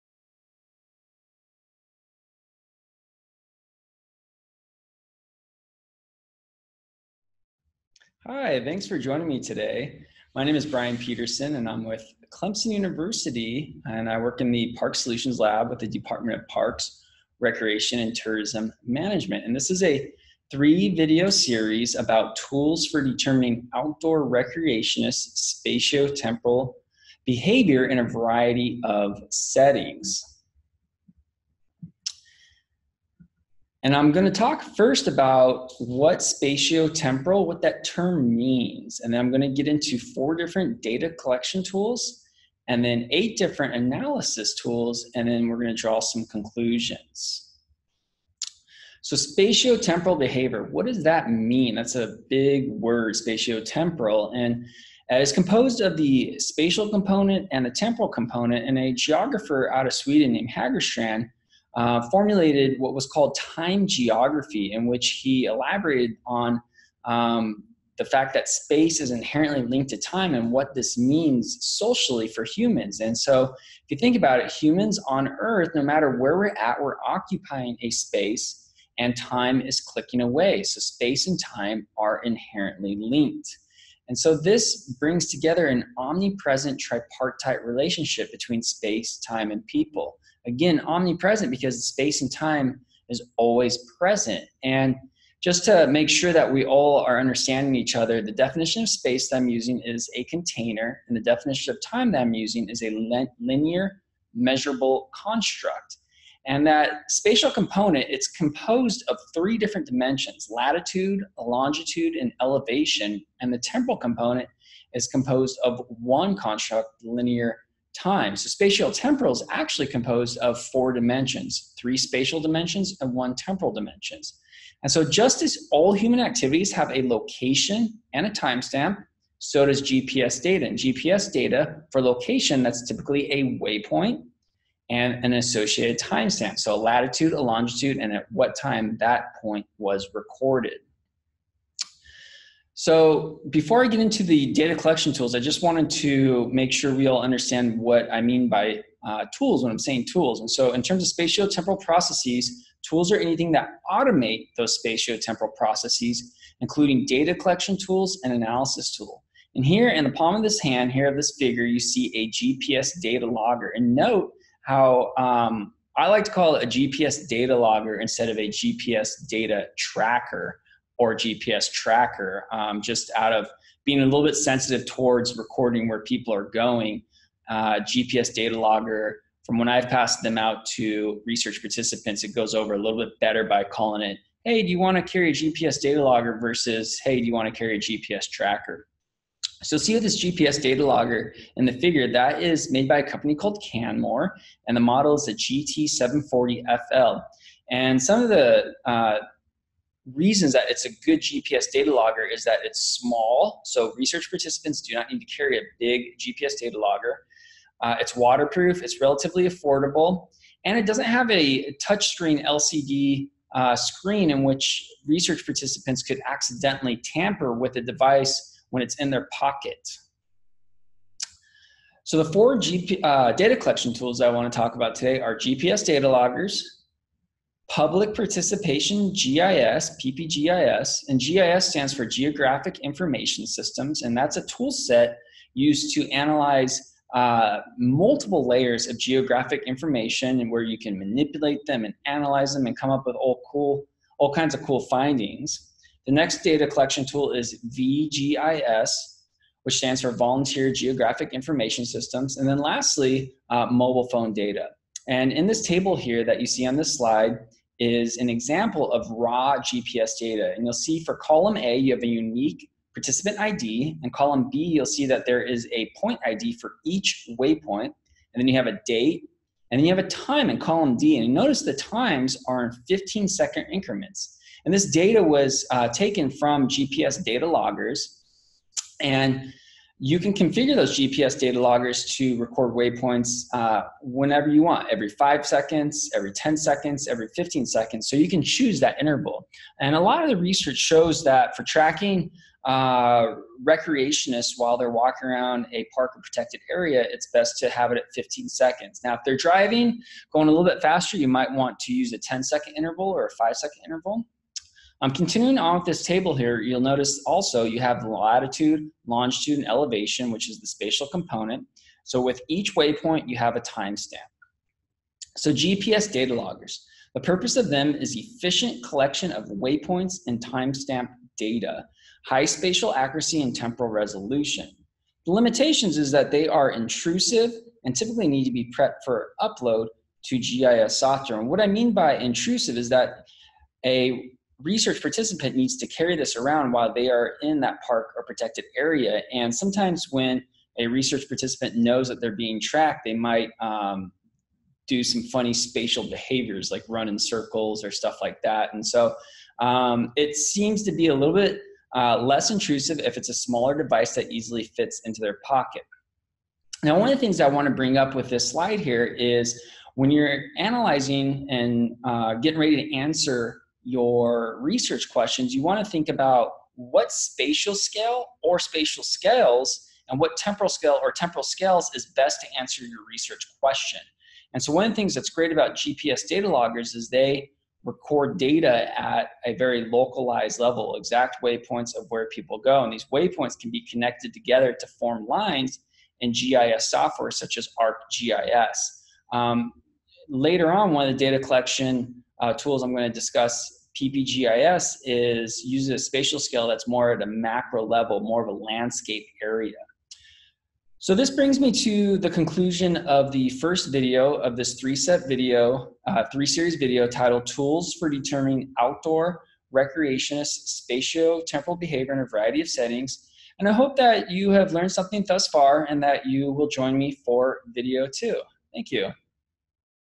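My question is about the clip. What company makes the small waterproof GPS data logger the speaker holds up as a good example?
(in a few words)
Canmore.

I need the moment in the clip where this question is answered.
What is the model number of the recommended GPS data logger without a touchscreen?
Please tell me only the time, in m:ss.
3:15.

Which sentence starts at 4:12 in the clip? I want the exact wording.
And then lastly, uh, mobile phone data.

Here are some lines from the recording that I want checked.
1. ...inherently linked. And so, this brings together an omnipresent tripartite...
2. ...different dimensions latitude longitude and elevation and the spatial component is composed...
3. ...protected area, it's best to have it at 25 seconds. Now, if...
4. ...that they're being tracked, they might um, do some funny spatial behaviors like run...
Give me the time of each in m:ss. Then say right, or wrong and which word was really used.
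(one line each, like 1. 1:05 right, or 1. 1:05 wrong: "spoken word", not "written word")
1. 1:22 right
2. 1:49 wrong: "temporal", not "spatial"
3. 4:56 wrong: "15", not "25"
4. 5:42 right.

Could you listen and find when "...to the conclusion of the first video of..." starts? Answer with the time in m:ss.
6:41.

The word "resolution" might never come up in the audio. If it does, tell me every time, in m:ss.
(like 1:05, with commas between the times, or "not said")
5:23.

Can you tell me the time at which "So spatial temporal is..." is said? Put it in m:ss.
1:58.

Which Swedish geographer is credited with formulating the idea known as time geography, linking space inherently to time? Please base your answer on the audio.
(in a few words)
Hagerstrand.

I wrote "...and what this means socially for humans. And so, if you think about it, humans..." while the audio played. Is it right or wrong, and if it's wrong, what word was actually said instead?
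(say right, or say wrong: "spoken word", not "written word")
right.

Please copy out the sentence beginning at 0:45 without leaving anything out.
And then we're going to draw some conclusions.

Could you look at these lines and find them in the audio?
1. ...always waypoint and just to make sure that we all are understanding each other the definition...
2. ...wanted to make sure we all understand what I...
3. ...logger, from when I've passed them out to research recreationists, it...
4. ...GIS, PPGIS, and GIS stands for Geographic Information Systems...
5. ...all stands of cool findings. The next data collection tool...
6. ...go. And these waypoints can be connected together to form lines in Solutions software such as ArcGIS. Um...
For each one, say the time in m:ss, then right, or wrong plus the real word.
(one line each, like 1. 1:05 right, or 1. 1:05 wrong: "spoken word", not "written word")
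1. 1:33 wrong: "present", not "waypoint"
2. 2:25 right
3. 2:58 wrong: "participants", not "recreationists"
4. 3:49 right
5. 4:04 wrong: "kinds", not "stands"
6. 6:22 wrong: "GIS", not "Solutions".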